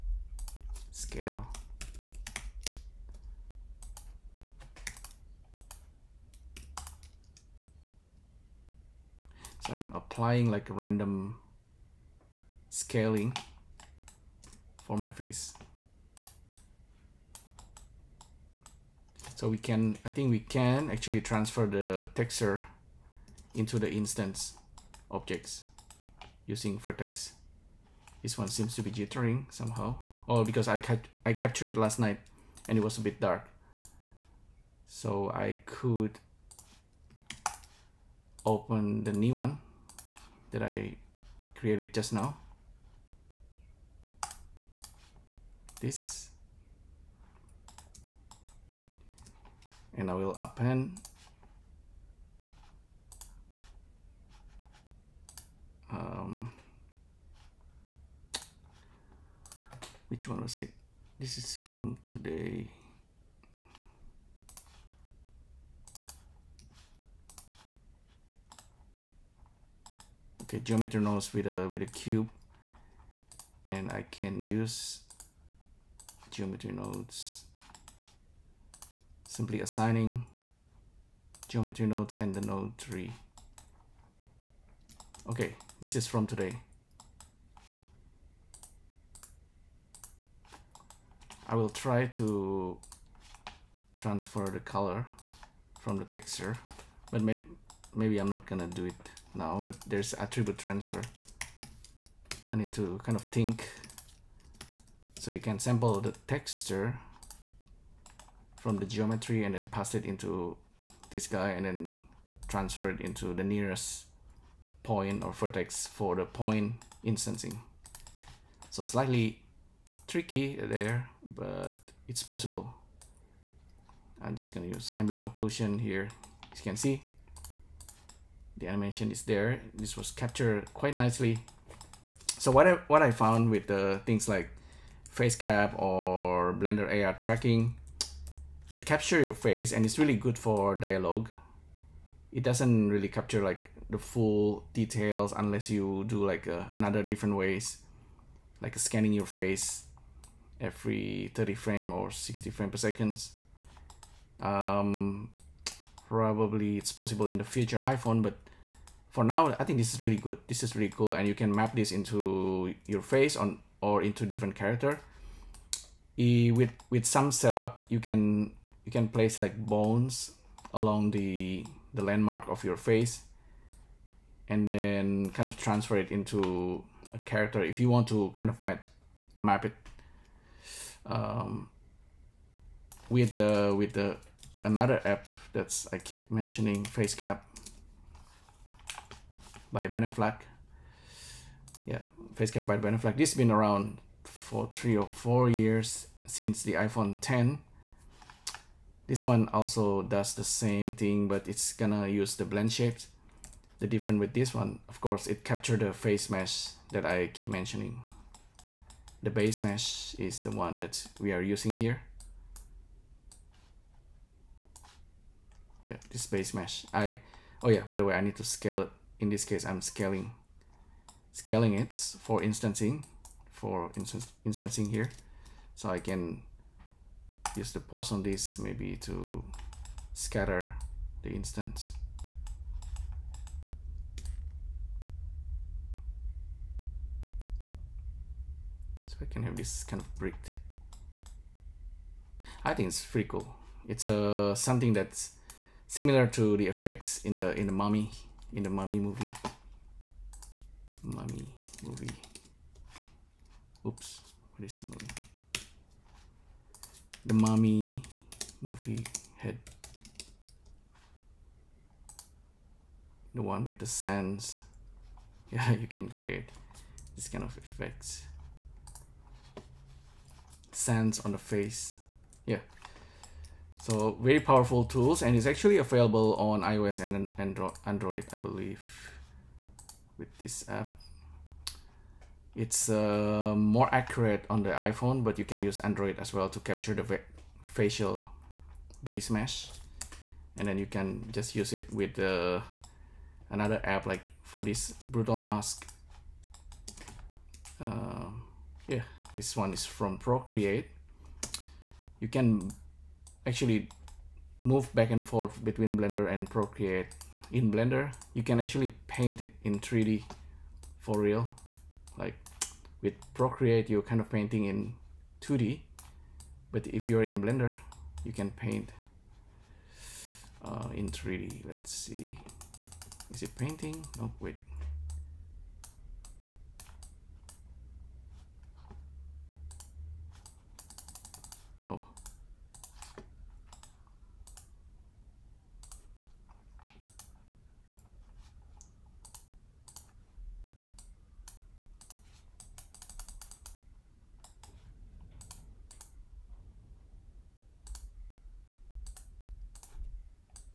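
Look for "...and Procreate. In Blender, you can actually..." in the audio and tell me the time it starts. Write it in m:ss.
5:06.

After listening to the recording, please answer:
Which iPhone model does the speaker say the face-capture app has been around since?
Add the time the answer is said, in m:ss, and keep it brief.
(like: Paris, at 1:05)
iPhone 10, at 3:16.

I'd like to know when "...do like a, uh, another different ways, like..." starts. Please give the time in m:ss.
2:26.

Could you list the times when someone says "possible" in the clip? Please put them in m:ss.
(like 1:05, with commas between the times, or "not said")
2:02, 2:36.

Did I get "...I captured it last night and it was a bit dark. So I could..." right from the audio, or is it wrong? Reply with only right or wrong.
right.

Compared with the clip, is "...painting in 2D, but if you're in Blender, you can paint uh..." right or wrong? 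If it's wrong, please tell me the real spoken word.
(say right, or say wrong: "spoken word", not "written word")
right.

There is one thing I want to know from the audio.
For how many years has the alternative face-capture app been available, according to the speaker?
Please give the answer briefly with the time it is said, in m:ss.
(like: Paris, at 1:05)
Three or four years, at 3:14.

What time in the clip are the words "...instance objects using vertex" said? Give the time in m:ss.
0:23.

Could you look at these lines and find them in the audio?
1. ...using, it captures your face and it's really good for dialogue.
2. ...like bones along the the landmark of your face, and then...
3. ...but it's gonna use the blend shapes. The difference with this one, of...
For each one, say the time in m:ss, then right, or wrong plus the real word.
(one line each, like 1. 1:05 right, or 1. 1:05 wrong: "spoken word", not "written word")
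1. 2:17 wrong: "tracking", not "using"
2. 2:49 right
3. 3:21 right.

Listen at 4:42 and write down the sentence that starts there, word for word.
It's uh, more accurate on the iPhone, but you can use Android as well to capture the facial base mesh.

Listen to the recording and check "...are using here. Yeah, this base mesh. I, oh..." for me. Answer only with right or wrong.
right.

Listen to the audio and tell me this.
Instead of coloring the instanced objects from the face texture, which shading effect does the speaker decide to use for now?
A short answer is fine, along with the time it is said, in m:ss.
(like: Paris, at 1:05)
Ambient occlusion, at 2:04.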